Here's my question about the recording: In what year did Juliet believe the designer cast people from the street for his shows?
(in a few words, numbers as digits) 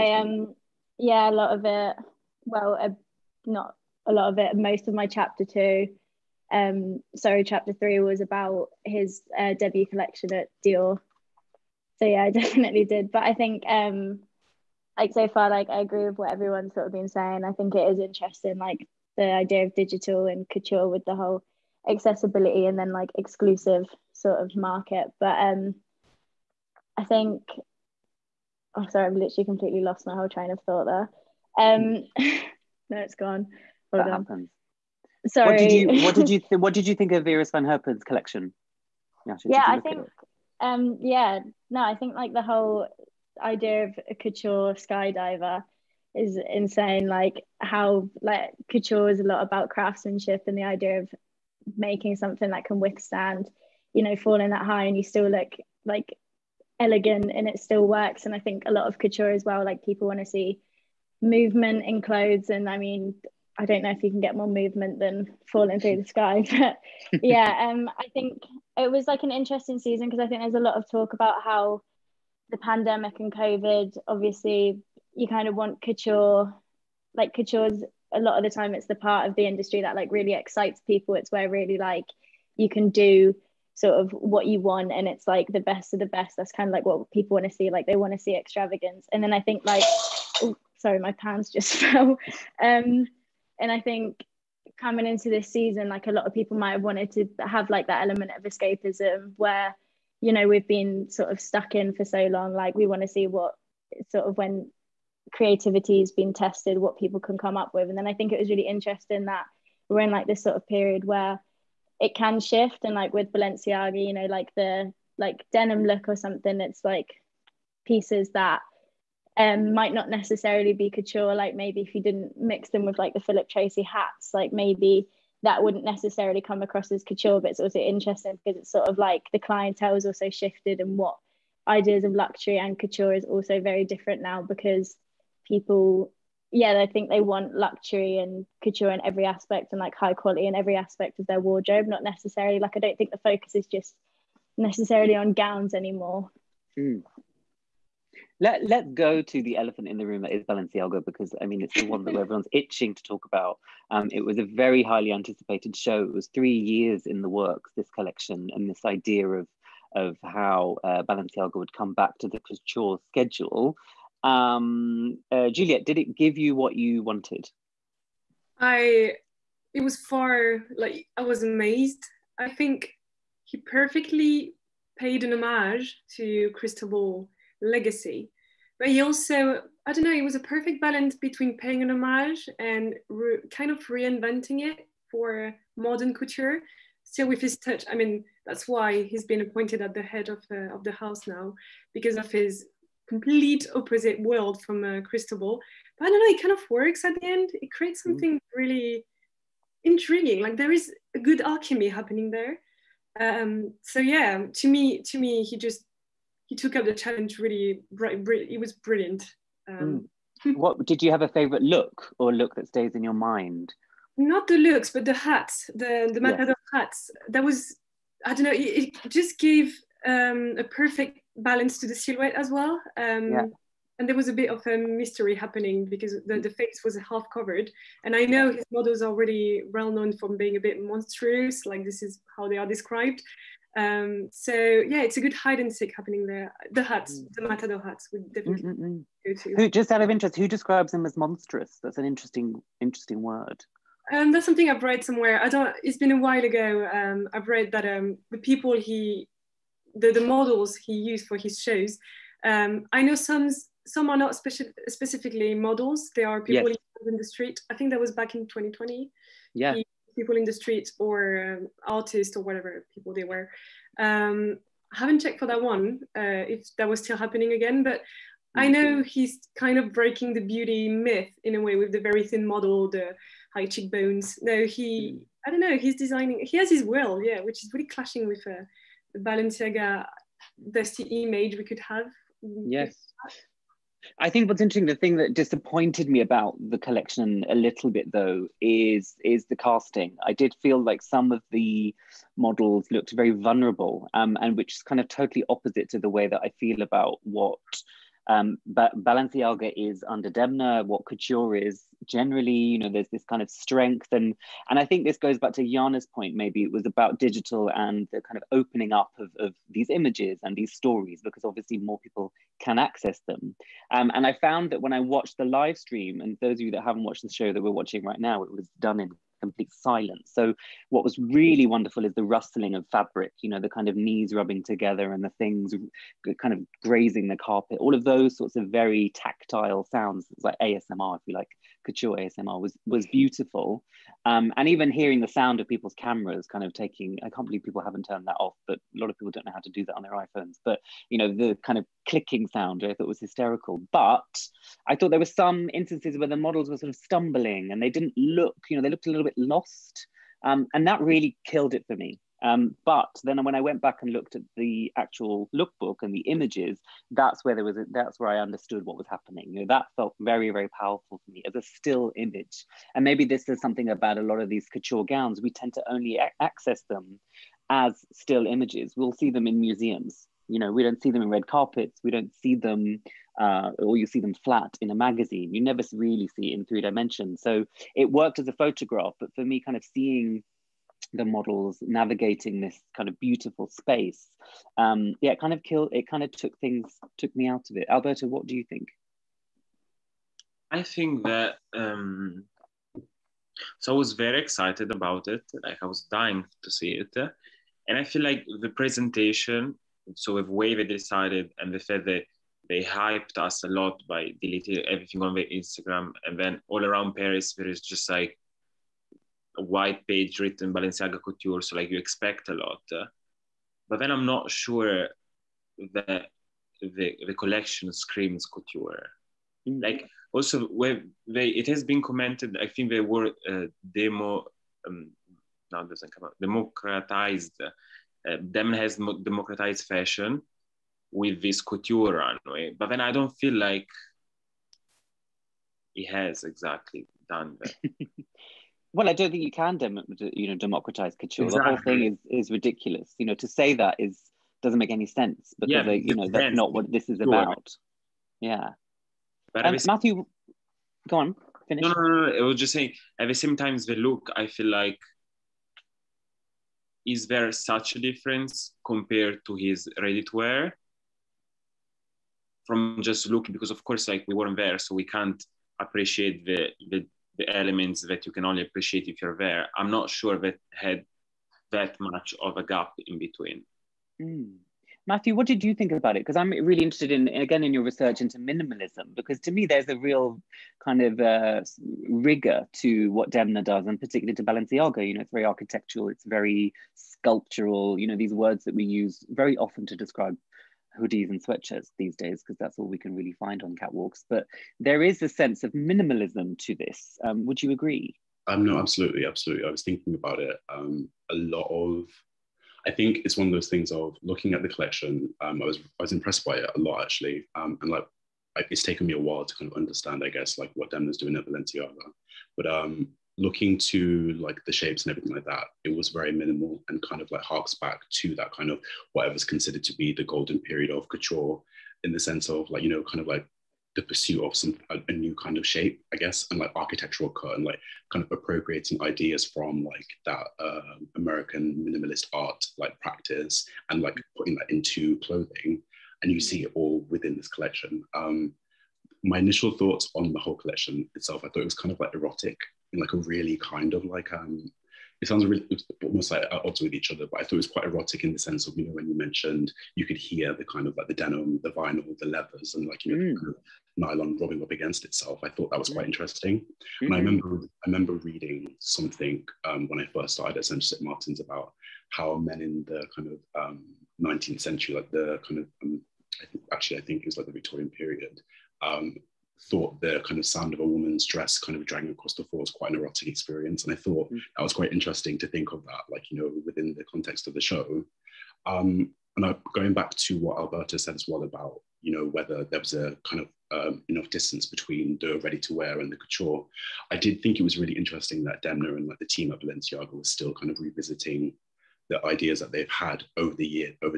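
2020.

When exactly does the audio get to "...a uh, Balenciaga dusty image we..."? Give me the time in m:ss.
4:38.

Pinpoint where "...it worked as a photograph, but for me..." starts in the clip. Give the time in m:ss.
6:17.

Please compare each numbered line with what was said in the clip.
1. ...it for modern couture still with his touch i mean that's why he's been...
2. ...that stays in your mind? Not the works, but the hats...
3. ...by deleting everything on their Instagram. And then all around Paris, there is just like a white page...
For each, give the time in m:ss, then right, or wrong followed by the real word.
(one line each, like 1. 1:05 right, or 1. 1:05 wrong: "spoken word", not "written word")
1. 3:04 right
2. 3:32 wrong: "looks", not "works"
3. 6:44 right.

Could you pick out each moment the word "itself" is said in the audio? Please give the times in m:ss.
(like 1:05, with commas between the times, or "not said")
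9:01, 9:15.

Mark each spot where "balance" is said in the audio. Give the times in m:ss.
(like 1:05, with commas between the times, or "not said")
3:00, 3:41.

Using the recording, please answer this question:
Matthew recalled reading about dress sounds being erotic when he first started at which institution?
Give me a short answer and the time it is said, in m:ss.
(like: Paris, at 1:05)
St. Martin's, at 9:20.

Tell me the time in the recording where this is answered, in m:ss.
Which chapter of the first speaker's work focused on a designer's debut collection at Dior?
0:07.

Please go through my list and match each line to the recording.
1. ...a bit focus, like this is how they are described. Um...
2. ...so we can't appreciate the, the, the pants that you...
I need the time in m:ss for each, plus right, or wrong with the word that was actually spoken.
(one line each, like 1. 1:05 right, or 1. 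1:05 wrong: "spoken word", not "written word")
1. 3:50 wrong: "monstrous", not "focus"
2. 7:44 wrong: "elements", not "pants".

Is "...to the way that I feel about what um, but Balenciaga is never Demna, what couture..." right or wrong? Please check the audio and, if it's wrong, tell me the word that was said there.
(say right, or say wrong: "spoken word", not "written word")
wrong: "under", not "never".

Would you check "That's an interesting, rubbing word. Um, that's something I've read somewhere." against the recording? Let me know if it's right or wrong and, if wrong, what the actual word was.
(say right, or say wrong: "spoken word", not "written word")
wrong: "interesting", not "rubbing".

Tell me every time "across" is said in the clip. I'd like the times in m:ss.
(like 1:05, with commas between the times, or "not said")
2:06, 9:32.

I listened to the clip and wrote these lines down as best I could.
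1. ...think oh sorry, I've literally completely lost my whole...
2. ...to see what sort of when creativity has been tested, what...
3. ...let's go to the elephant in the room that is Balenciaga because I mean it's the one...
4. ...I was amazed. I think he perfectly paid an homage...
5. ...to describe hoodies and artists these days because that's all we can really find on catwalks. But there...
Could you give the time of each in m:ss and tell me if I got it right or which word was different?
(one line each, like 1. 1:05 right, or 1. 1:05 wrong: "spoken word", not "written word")
1. 0:27 right
2. 1:43 right
3. 2:28 right
4. 2:51 right
5. 8:09 wrong: "sweatshirts", not "artists".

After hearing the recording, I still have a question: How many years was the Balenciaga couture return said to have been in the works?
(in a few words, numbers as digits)
3.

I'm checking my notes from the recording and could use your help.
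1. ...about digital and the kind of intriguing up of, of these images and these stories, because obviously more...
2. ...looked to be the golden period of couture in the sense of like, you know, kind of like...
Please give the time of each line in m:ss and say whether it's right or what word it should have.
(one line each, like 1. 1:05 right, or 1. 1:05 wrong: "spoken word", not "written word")
1. 5:06 wrong: "opening", not "intriguing"
2. 8:39 wrong: "considered", not "looked".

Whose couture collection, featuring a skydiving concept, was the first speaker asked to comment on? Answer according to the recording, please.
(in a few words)
Vera van Herpen.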